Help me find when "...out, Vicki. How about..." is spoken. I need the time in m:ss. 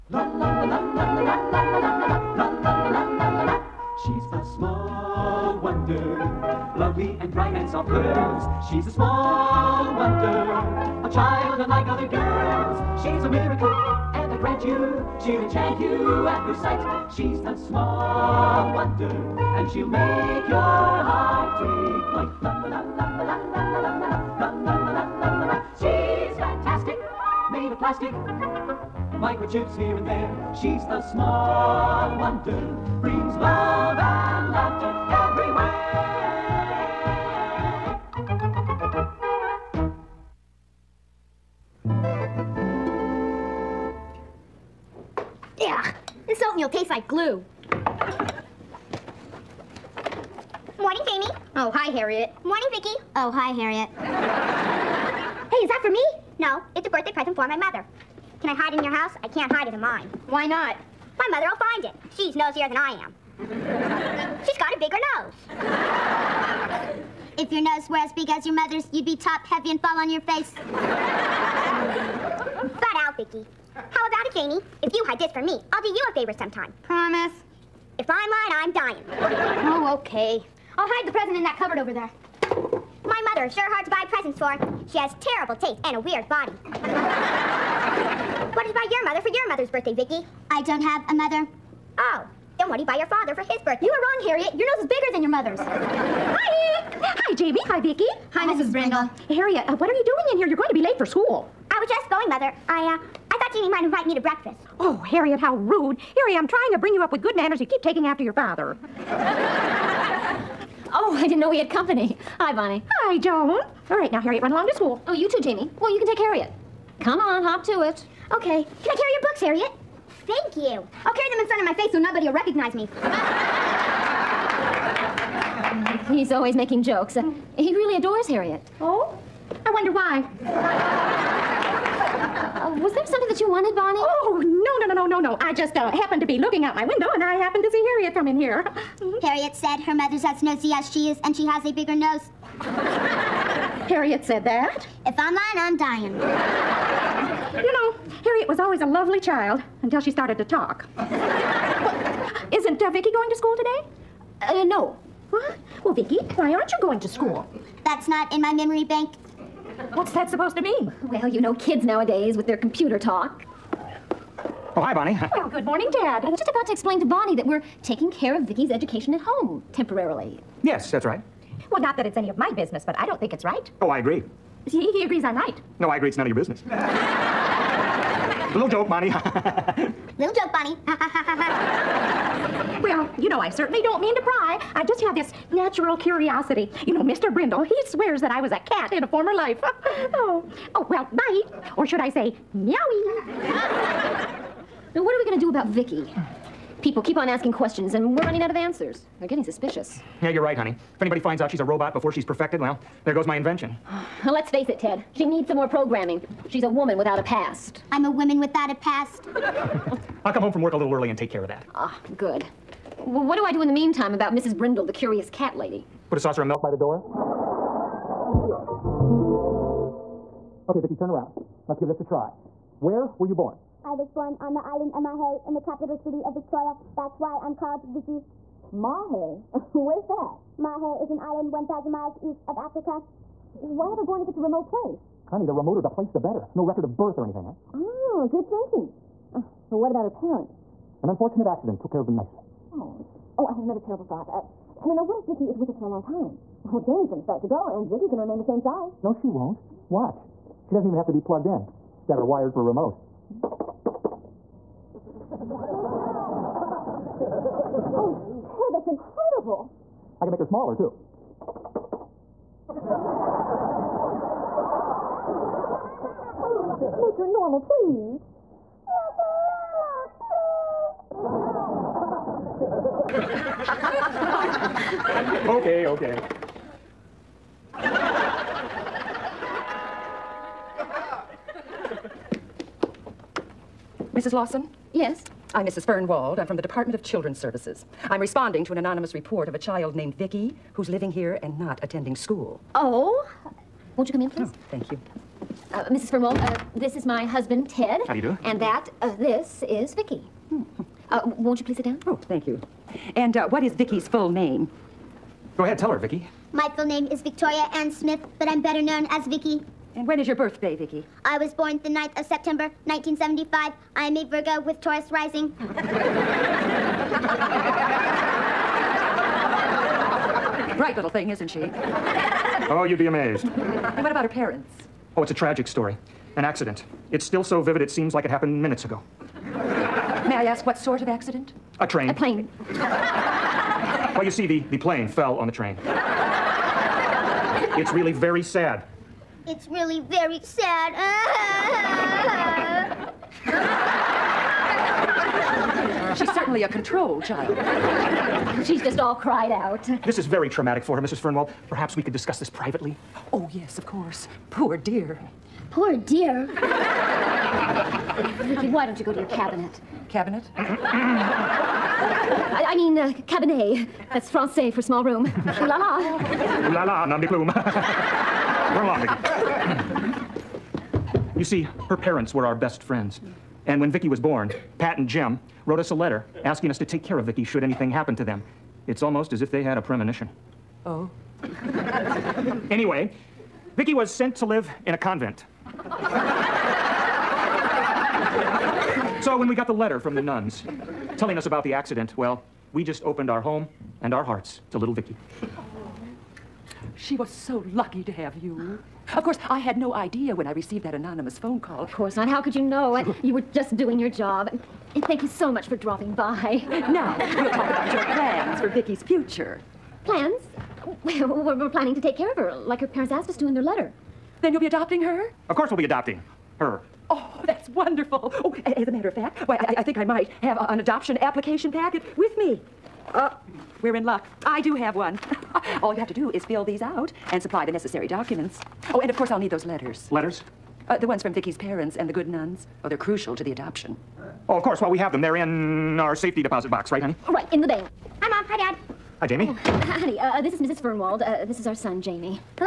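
1:12.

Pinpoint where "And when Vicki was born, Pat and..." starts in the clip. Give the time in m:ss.
6:13.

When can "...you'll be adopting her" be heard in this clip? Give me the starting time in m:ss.
6:54.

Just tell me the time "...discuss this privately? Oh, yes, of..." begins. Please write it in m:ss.
5:52.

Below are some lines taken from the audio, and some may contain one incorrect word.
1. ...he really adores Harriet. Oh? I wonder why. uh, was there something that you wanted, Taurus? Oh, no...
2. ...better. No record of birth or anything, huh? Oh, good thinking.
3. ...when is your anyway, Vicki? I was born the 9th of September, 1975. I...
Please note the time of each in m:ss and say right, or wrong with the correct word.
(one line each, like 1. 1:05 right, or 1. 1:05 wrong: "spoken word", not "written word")
1. 2:07 wrong: "Bonnie", not "Taurus"
2. 3:56 right
3. 5:10 wrong: "birthday", not "anyway".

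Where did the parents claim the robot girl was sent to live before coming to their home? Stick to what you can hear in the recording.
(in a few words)
A convent.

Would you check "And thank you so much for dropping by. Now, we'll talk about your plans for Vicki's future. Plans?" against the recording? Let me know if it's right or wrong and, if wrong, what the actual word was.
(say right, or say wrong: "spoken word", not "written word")
right.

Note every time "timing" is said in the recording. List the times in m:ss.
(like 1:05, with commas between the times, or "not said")
not said.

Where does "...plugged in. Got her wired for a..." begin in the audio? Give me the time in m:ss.
4:11.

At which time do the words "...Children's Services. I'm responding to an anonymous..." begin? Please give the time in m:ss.
4:47.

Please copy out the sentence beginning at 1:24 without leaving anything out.
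She has terrible taste and a weird body.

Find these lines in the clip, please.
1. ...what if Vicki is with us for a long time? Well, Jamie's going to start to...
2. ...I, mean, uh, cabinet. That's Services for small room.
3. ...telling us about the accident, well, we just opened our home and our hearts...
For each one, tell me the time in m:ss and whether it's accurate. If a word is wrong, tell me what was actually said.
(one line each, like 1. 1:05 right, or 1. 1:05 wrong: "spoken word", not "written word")
1. 4:05 right
2. 6:02 wrong: "Francais", not "Services"
3. 6:31 right.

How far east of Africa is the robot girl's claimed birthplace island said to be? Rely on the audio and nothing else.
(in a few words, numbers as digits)
1,000 miles.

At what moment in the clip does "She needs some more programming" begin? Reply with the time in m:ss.
3:25.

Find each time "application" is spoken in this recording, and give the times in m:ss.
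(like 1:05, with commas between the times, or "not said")
7:01.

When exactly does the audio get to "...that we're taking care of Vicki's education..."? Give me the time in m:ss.
2:47.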